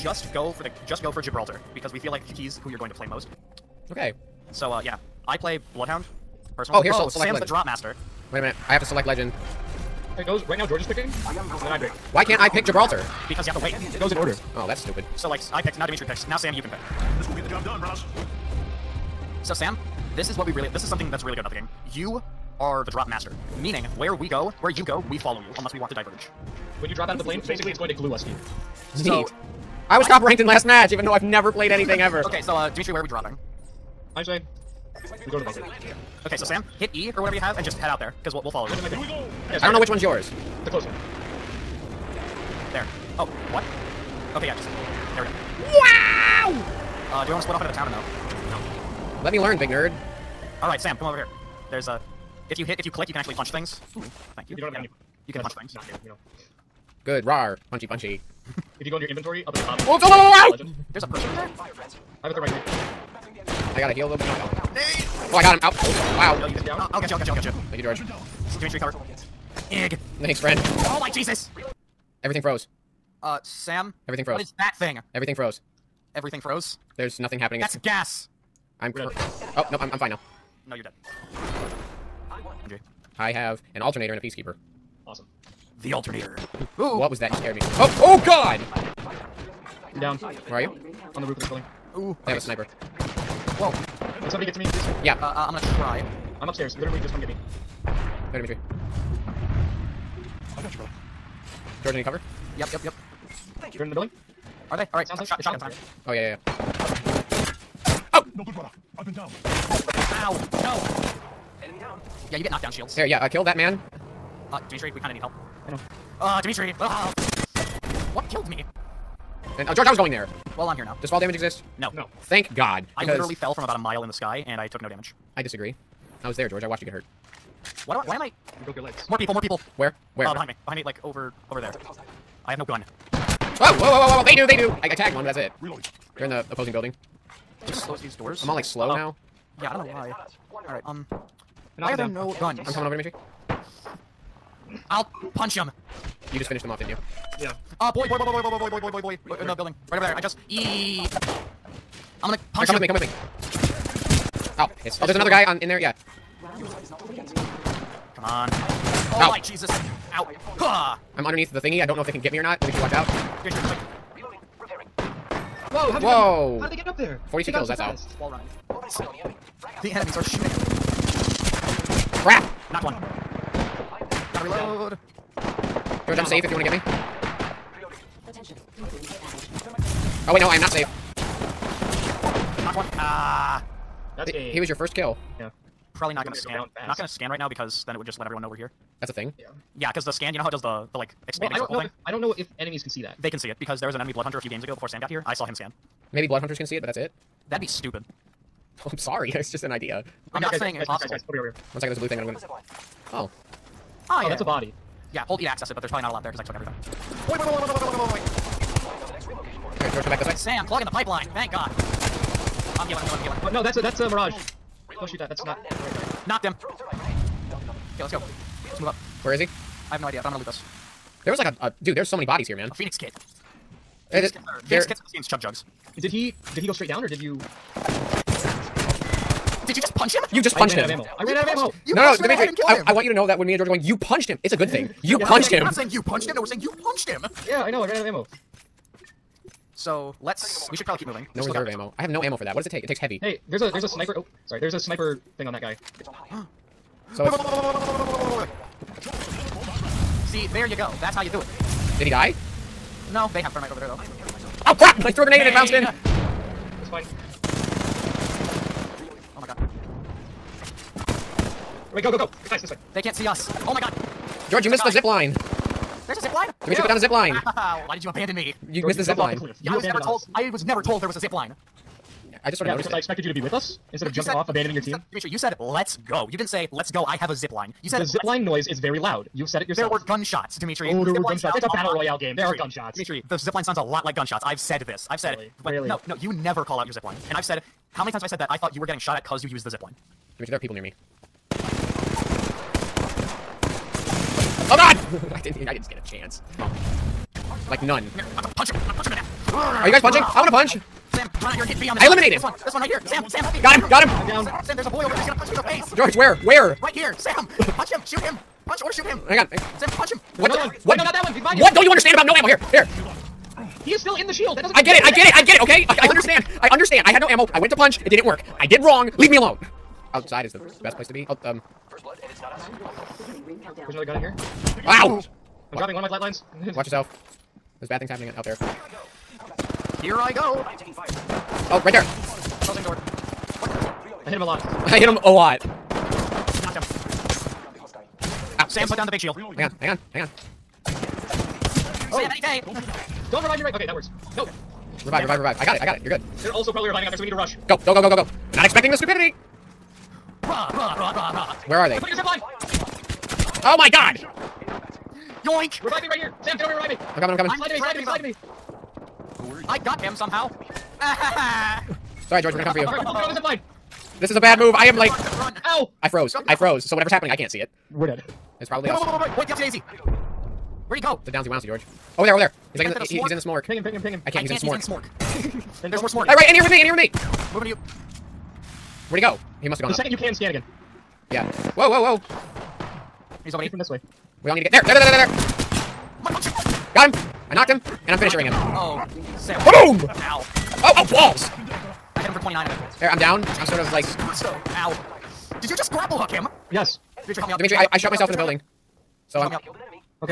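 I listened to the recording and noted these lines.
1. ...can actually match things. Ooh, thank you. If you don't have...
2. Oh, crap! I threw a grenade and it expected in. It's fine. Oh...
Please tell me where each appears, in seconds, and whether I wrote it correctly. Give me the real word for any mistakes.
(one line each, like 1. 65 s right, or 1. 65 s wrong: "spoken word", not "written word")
1. 53 s wrong: "punch", not "match"
2. 254 s wrong: "bounced", not "expected".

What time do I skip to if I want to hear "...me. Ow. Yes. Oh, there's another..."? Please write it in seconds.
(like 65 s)
153 s.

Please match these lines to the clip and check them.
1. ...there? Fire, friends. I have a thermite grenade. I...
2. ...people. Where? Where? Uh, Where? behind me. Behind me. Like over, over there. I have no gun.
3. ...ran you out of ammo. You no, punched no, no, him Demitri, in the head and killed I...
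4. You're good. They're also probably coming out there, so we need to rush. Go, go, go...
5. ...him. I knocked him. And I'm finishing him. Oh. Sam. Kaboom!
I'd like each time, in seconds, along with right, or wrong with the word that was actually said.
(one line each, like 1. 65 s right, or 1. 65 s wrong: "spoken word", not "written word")
1. 61 s right
2. 129 s right
3. 231 s right
4. 346 s wrong: "reviving", not "coming"
5. 387 s right.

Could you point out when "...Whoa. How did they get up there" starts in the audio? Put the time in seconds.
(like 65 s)
166 s.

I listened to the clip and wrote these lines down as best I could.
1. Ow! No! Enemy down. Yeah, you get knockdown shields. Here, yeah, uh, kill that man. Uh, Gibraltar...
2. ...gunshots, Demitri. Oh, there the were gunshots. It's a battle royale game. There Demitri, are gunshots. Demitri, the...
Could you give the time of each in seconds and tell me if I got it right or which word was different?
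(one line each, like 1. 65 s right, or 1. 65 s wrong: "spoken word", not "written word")
1. 109 s wrong: "Demitri", not "Gibraltar"
2. 280 s right.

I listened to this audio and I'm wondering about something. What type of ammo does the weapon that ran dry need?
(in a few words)
Heavy.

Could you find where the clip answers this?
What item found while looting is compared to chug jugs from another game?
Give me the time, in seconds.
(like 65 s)
222 s.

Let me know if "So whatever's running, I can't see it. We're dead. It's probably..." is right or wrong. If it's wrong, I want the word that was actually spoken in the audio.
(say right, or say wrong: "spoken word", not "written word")
wrong: "happening", not "running".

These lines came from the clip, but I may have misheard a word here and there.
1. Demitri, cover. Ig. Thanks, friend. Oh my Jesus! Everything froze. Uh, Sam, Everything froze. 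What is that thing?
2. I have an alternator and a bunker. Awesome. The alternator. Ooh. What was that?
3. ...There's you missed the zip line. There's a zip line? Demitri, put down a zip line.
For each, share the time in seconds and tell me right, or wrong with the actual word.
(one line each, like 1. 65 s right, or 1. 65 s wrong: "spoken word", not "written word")
1. 68 s right
2. 83 s wrong: "peacekeeper", not "bunker"
3. 264 s right.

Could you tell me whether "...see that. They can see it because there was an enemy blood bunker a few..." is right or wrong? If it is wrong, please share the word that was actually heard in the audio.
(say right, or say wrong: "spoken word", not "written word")
wrong: "hunter", not "bunker".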